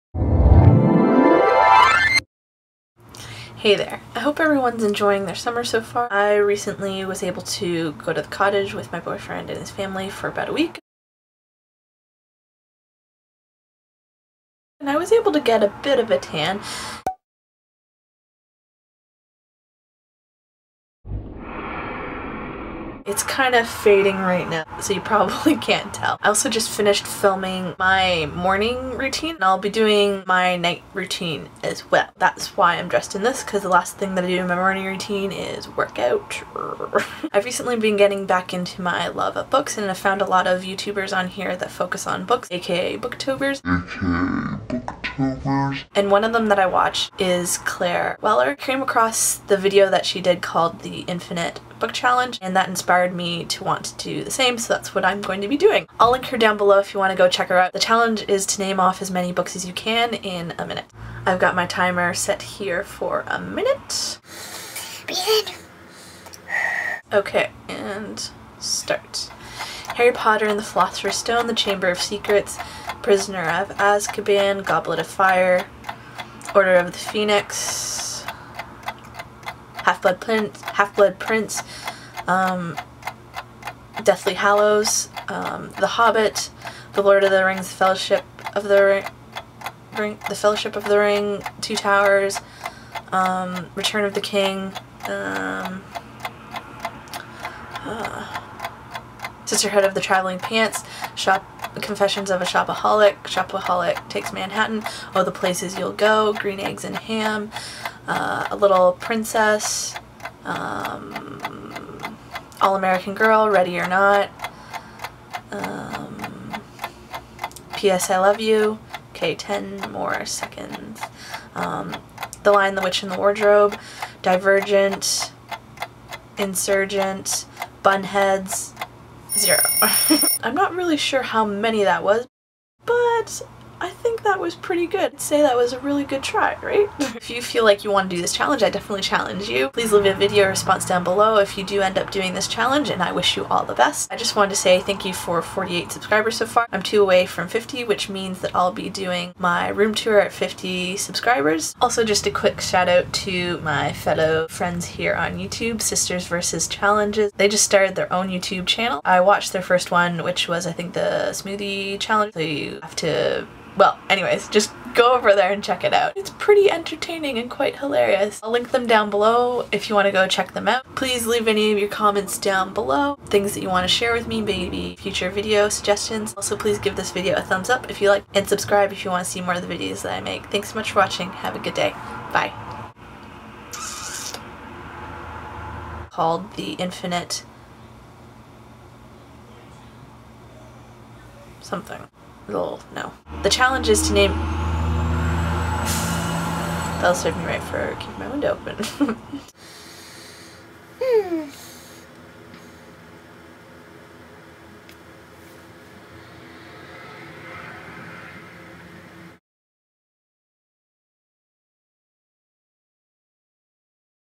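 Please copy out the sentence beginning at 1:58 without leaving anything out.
I Love You, okay, 10 more seconds, um, The Lion, the Witch, and the Wardrobe, Divergent, Insurgent, Bunheads, zero.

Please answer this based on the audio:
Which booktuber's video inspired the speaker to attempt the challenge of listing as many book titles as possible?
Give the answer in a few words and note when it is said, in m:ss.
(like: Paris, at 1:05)
Claire Weller, at 0:47.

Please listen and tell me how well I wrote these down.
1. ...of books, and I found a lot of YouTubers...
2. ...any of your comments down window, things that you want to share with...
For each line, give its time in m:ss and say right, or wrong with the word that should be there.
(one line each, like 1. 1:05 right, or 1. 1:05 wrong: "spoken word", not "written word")
1. 0:39 right
2. 2:51 wrong: "below", not "window".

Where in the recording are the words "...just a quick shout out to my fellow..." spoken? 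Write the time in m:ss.
2:32.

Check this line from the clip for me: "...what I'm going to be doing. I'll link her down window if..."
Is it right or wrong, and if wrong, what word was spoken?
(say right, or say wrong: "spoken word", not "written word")
wrong: "below", not "window".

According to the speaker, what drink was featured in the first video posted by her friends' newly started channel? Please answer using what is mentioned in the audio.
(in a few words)
smoothie.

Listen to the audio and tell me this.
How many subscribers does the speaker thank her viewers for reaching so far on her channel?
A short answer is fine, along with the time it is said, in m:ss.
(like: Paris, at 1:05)
48, at 2:25.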